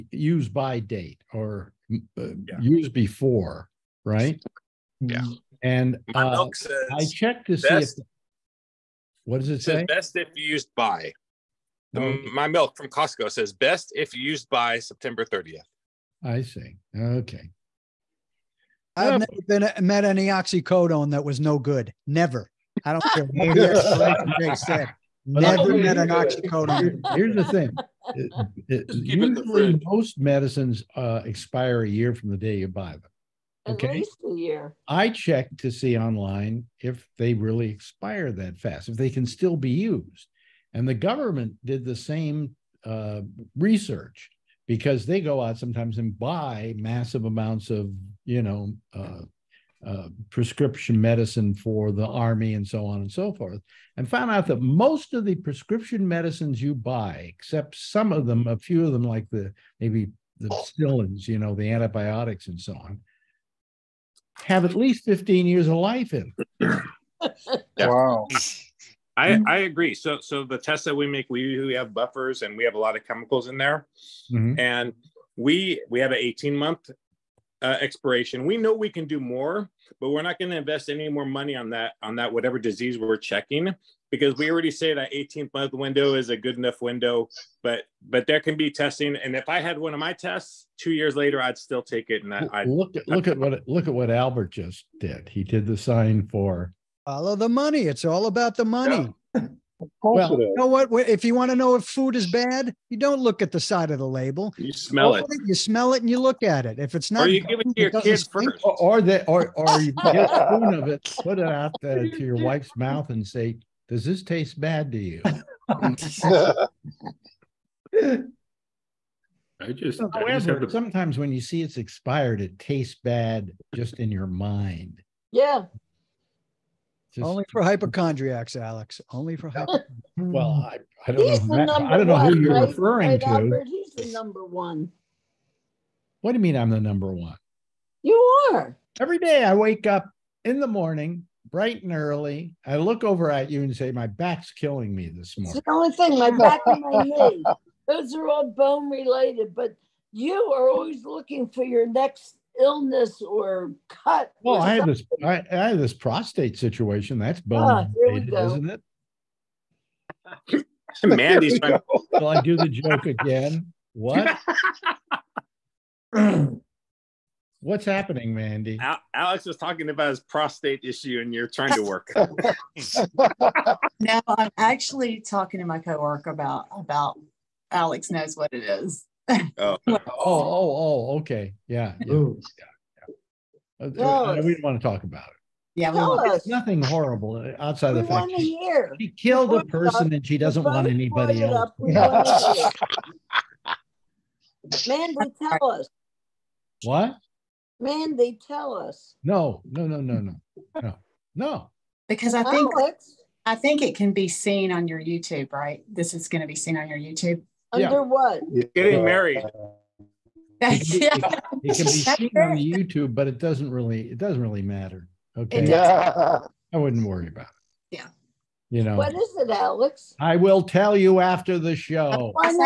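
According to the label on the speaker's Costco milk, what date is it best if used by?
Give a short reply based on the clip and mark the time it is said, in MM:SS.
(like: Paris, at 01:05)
September 30, at 00:14.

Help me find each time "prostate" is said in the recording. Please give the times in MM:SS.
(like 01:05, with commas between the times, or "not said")
02:35, 02:50.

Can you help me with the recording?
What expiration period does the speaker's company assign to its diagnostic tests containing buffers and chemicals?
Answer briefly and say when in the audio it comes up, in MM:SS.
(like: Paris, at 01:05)
18 months, at 01:16.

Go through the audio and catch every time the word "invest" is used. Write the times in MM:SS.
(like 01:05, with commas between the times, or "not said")
01:20.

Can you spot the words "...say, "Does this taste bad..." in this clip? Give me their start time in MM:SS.
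01:53.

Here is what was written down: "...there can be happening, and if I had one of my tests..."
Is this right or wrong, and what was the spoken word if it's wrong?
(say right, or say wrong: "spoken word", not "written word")
wrong: "testing", not "happening".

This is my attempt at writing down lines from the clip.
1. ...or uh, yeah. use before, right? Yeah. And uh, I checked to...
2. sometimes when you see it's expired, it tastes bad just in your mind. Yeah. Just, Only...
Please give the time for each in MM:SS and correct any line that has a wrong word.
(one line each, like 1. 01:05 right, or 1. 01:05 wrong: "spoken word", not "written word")
1. 00:01 right
2. 02:00 right.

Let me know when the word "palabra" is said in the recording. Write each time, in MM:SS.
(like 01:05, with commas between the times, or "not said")
not said.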